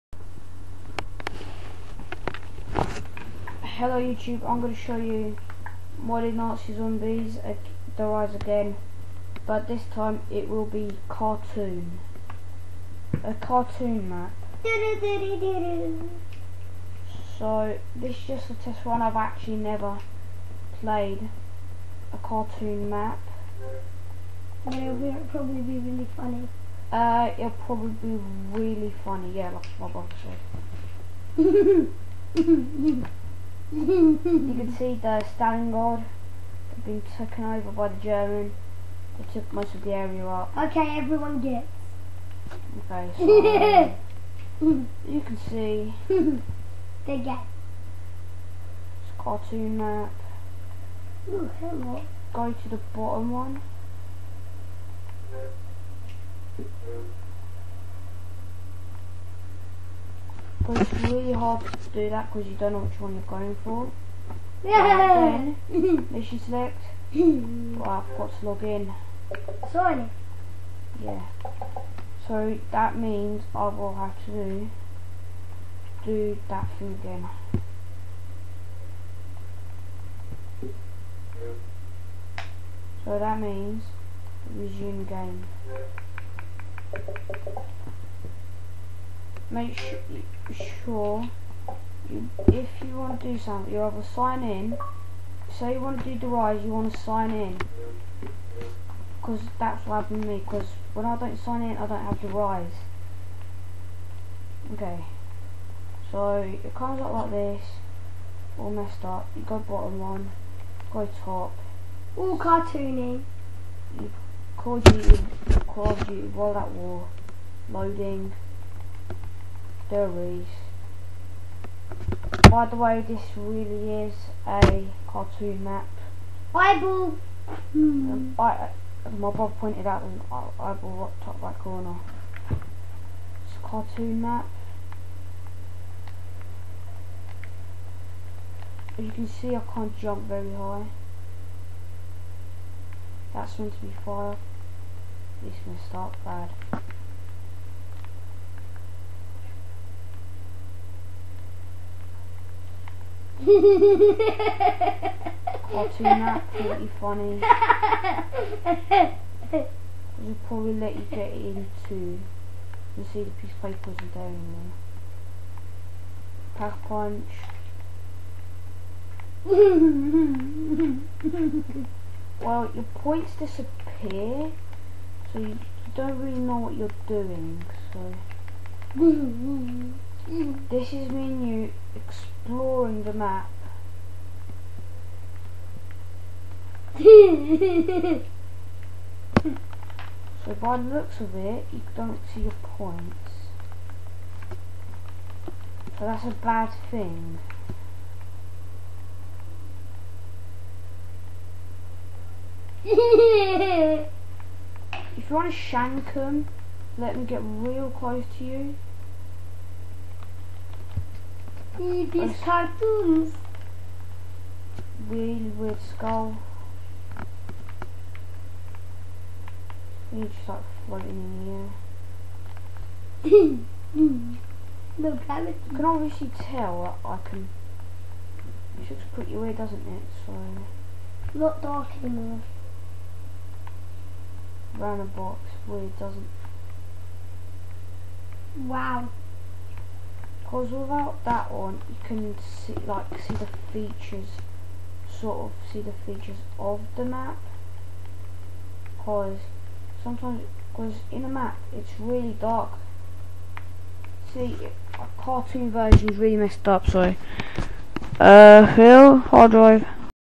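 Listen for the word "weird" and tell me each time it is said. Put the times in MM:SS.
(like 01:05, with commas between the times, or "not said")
03:35, 03:49, 03:55.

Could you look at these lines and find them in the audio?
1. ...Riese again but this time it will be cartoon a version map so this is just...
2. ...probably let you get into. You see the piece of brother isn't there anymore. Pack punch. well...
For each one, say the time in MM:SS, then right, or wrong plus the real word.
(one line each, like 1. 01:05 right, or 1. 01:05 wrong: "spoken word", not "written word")
1. 00:08 wrong: "cartoon", not "version"
2. 02:40 wrong: "paper", not "brother".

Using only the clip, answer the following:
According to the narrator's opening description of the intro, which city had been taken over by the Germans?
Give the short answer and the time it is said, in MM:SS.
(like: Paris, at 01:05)
Stalingrad, at 00:35.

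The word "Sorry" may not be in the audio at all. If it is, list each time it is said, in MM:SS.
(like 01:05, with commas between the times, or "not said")
01:09, 04:16.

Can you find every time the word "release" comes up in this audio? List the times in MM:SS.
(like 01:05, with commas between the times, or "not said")
not said.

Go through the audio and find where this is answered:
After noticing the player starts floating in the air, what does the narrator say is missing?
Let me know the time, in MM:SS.
03:44.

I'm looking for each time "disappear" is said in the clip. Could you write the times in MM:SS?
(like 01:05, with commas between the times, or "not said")
02:53.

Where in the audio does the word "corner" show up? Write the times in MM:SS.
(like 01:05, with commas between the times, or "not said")
02:11.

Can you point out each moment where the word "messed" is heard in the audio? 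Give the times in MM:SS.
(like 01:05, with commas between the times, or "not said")
01:48, 04:16.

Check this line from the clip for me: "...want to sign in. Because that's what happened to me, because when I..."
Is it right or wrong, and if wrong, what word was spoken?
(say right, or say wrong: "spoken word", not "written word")
right.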